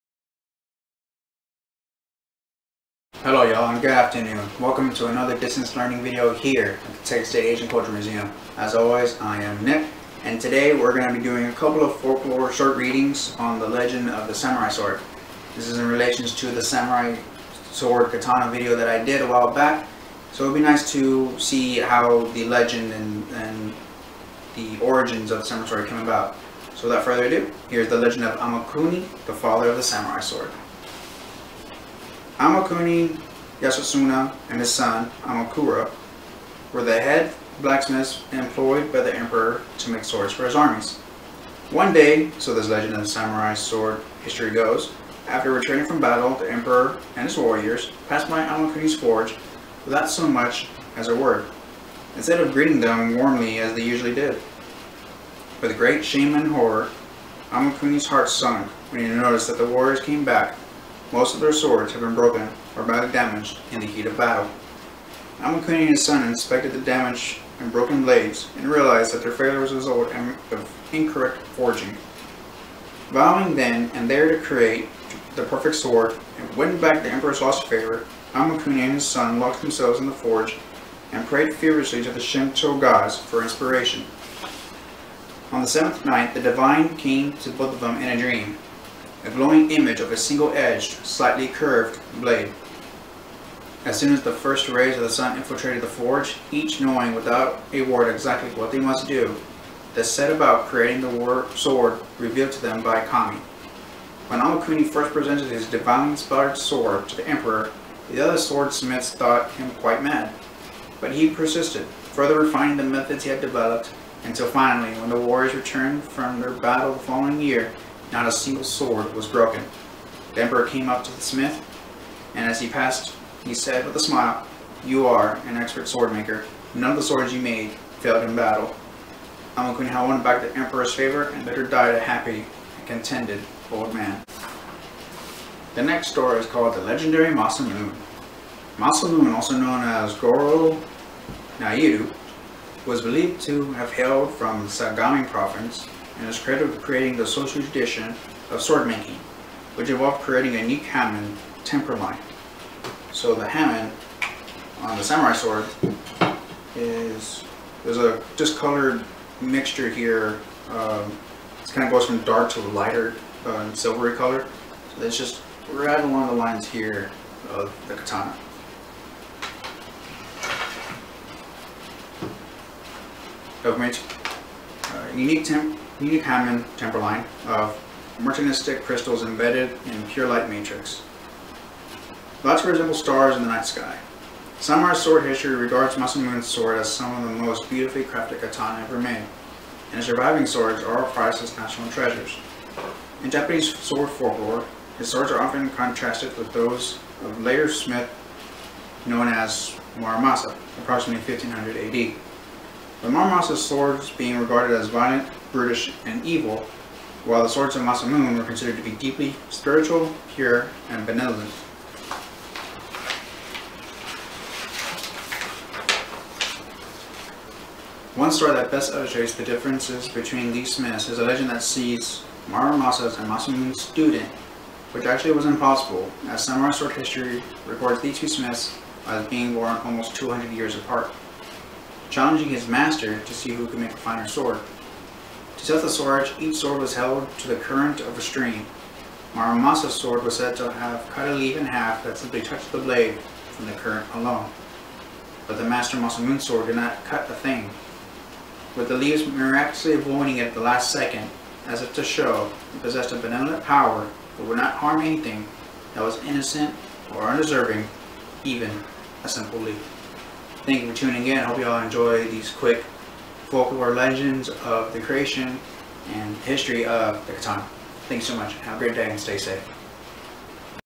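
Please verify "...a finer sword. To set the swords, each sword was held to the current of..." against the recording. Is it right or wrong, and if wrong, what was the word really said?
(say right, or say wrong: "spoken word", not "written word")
right.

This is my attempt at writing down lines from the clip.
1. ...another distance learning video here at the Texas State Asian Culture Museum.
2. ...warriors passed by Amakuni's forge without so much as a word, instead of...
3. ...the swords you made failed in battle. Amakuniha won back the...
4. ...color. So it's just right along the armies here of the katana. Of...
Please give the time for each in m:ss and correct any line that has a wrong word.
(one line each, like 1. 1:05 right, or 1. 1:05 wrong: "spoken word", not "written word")
1. 0:05 right
2. 0:47 right
3. 2:06 right
4. 2:44 wrong: "lines", not "armies".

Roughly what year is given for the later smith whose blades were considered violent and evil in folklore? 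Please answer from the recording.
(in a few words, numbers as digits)
1500 AD.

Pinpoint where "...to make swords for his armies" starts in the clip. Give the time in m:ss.
0:39.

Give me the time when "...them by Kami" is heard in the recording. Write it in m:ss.
1:42.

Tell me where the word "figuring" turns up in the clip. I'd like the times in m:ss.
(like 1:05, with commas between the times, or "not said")
not said.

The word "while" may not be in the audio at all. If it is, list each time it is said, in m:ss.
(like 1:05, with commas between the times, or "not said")
0:19, 3:27.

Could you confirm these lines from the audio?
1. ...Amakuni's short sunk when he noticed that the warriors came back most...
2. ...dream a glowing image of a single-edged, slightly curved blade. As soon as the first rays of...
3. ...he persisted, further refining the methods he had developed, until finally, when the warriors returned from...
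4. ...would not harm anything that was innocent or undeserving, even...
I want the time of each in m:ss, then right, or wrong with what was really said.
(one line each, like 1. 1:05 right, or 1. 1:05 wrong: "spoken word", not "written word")
1. 0:57 wrong: "heart", not "short"
2. 1:28 right
3. 1:51 right
4. 4:14 right.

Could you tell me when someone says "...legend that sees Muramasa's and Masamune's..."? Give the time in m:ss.
3:41.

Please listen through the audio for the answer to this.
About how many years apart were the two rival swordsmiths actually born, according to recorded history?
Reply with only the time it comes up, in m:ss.
3:49.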